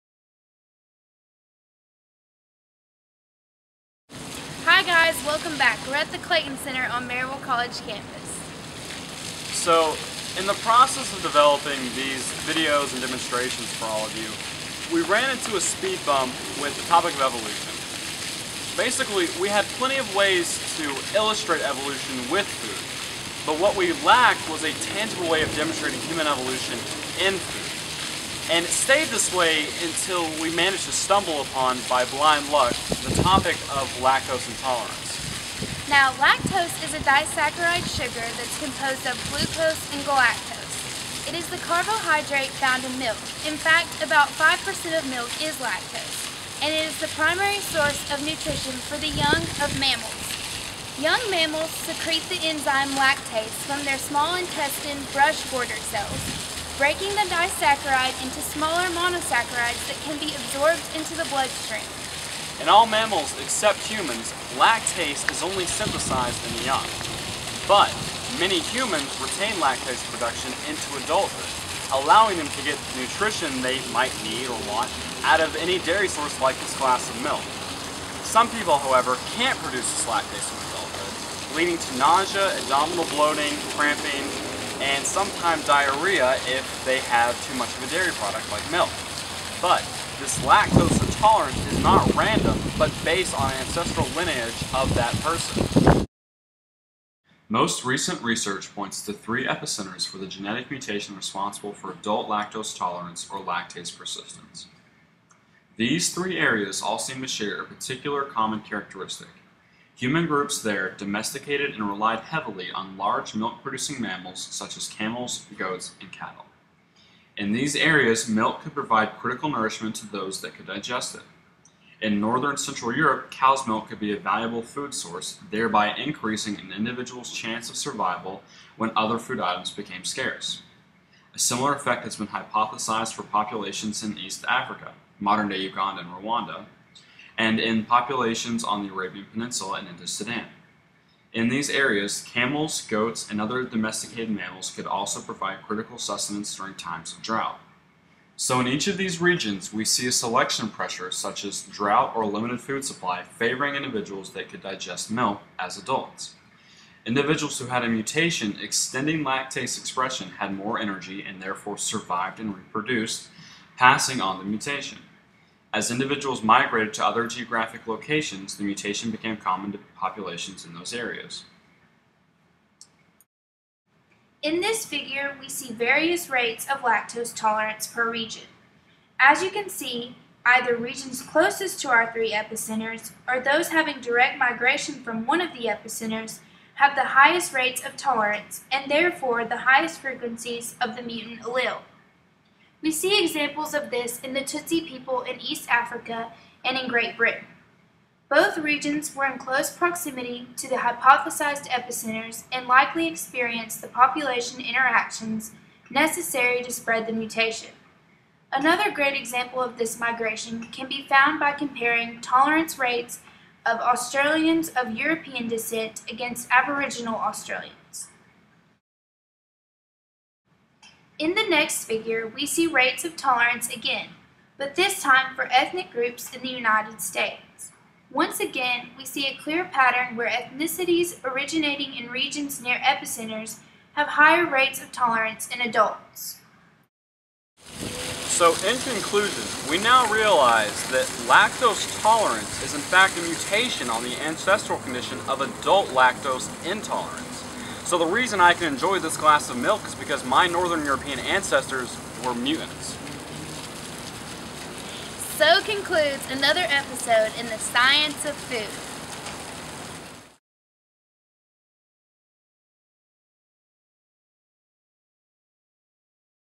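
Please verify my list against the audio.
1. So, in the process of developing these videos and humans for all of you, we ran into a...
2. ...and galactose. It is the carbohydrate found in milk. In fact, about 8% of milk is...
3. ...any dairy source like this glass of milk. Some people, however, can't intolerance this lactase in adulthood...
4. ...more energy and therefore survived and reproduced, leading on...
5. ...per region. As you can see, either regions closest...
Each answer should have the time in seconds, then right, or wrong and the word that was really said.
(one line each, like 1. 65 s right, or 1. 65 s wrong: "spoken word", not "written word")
1. 9 s wrong: "demonstrations", not "humans"
2. 39 s wrong: "5", not "8"
3. 75 s wrong: "produce", not "intolerance"
4. 160 s wrong: "passing", not "leading"
5. 177 s right.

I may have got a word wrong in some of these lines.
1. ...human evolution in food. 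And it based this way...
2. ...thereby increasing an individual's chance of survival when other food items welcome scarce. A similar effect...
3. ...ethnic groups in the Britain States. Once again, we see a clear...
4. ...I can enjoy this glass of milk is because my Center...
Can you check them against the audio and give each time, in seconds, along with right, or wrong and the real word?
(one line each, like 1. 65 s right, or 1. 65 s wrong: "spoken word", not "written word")
1. 26 s wrong: "stayed", not "based"
2. 125 s wrong: "became", not "welcome"
3. 225 s wrong: "United", not "Britain"
4. 248 s wrong: "Northern", not "Center".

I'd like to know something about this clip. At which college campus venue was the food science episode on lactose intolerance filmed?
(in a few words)
Clayton Center.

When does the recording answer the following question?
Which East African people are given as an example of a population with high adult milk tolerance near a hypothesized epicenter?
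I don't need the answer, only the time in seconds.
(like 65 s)
194 s.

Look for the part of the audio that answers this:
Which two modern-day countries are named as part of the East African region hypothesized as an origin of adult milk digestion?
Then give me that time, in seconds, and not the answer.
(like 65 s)
135 s.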